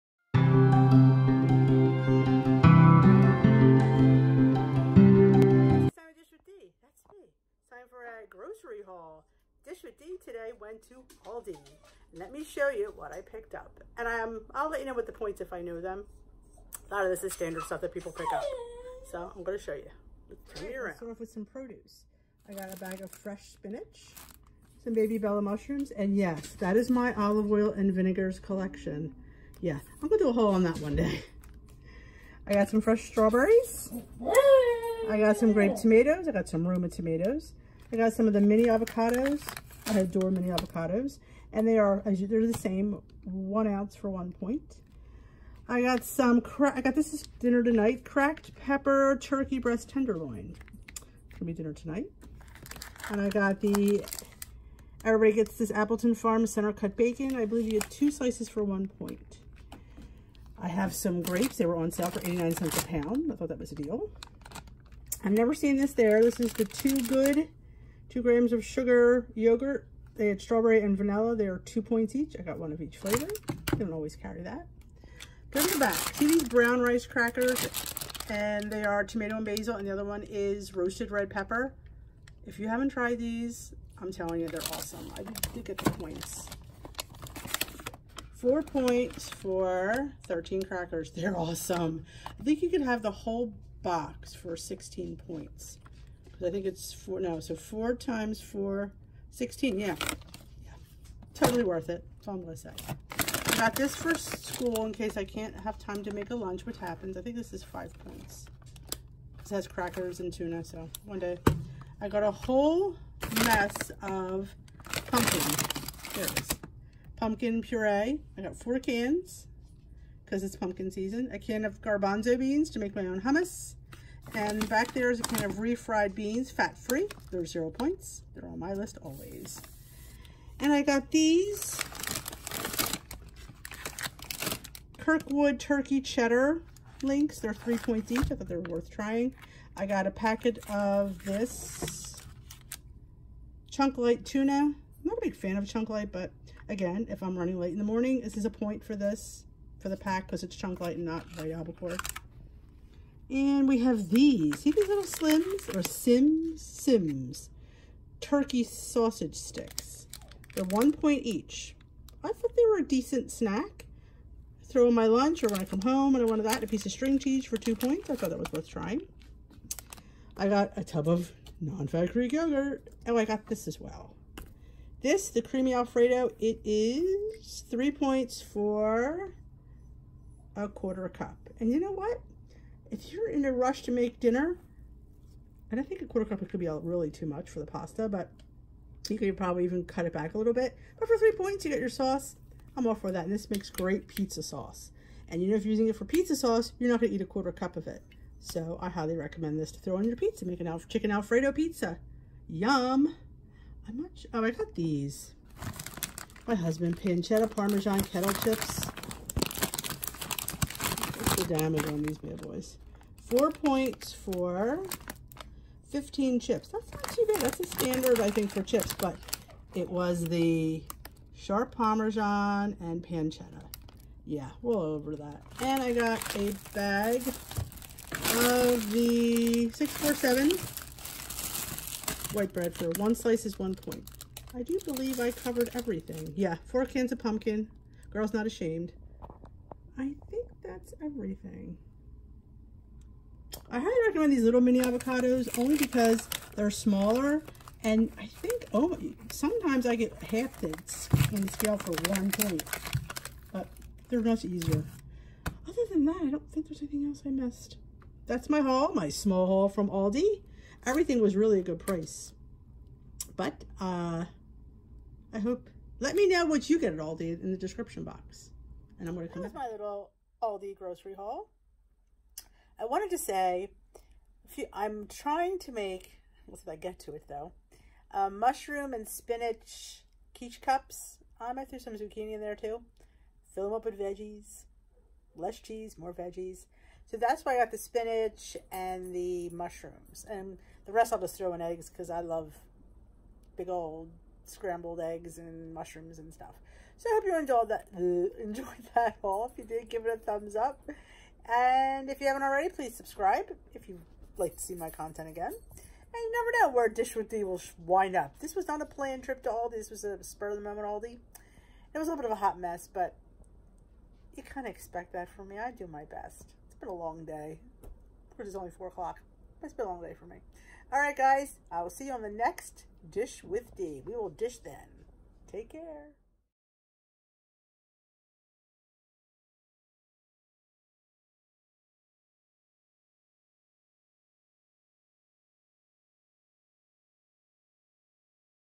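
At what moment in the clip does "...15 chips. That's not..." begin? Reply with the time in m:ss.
3:35.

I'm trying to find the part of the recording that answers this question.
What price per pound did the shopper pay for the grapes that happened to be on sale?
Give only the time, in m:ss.
1:02.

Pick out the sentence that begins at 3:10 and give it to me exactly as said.
But for three points, you get your sauce.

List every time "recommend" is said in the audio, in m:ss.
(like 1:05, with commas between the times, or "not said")
3:19, 4:04.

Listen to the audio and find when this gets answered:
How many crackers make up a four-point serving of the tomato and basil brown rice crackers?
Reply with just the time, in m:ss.
1:30.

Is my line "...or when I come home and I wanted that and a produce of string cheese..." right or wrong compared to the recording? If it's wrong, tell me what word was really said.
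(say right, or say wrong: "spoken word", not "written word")
wrong: "piece", not "produce".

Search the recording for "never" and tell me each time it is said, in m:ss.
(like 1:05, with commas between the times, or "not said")
1:05, 5:06.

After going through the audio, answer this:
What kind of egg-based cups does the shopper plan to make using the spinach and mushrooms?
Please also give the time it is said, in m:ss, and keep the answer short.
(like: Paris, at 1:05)
quiche cups, at 4:40.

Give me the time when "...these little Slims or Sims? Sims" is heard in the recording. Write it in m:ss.
2:34.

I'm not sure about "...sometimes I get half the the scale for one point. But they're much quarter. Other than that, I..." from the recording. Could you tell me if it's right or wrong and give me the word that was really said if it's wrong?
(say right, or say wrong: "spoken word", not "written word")
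wrong: "easier", not "quarter".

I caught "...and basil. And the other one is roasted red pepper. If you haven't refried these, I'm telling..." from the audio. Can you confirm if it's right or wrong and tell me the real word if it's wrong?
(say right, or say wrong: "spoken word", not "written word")
wrong: "tried", not "refried".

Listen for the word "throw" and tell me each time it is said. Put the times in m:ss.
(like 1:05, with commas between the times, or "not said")
2:44, 3:19, 4:41, 4:51.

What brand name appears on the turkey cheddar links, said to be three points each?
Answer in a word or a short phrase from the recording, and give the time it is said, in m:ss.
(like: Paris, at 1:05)
Kirkwood, at 2:14.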